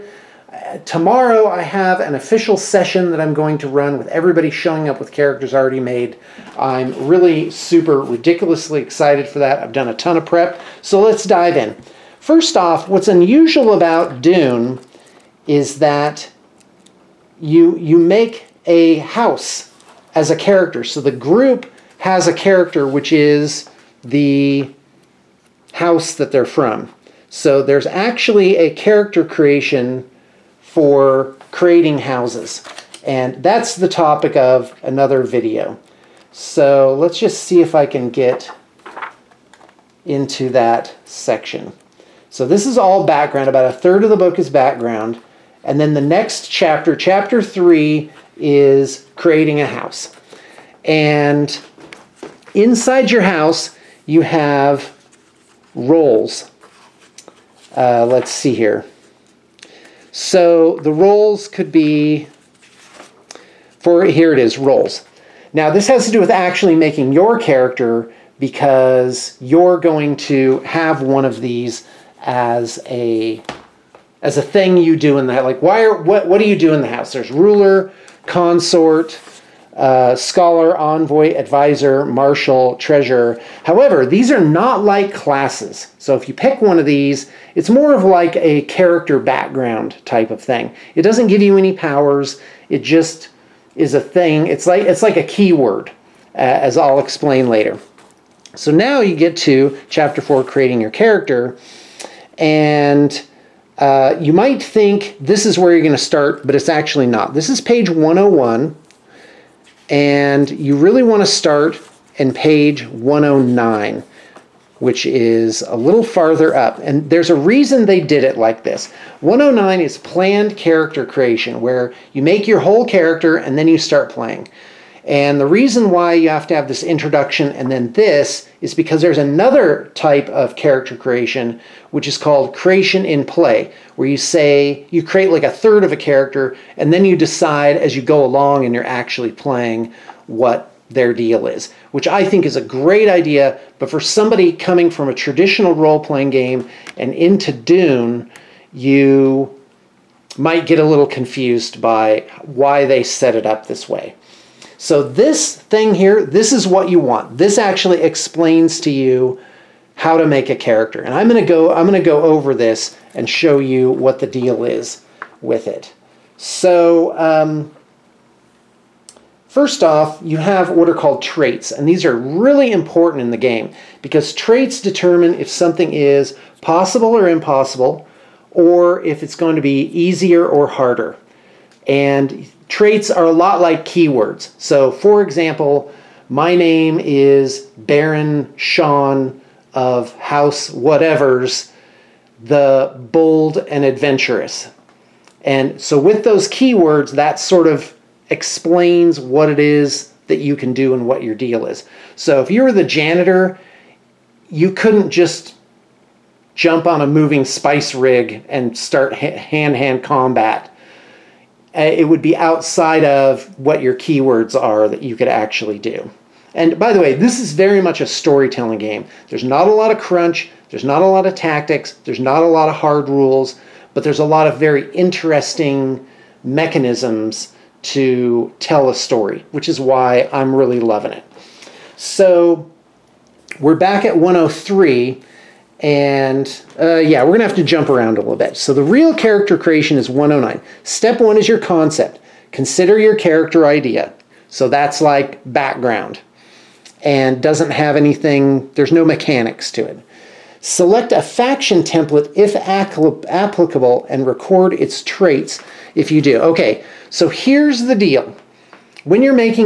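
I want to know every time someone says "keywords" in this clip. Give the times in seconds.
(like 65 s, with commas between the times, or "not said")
95 s, 183 s, 196 s, 213 s.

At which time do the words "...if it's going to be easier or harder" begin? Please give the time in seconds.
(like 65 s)
179 s.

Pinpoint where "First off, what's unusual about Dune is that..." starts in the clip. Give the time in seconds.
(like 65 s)
12 s.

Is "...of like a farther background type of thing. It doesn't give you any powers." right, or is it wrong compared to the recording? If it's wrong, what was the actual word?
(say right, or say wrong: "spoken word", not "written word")
wrong: "character", not "farther".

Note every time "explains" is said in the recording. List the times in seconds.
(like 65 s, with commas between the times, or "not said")
96 s, 158 s, 198 s.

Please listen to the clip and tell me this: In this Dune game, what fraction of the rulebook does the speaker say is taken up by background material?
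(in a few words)
About a third.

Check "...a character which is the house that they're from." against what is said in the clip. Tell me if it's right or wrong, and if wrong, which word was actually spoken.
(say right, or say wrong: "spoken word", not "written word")
right.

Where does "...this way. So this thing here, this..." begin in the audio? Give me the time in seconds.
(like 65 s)
153 s.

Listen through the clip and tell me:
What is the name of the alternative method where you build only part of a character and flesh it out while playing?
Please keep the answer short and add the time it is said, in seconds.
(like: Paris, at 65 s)
Creation in play, at 132 s.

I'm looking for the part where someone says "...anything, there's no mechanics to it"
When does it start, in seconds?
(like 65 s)
247 s.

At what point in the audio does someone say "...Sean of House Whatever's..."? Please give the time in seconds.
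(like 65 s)
188 s.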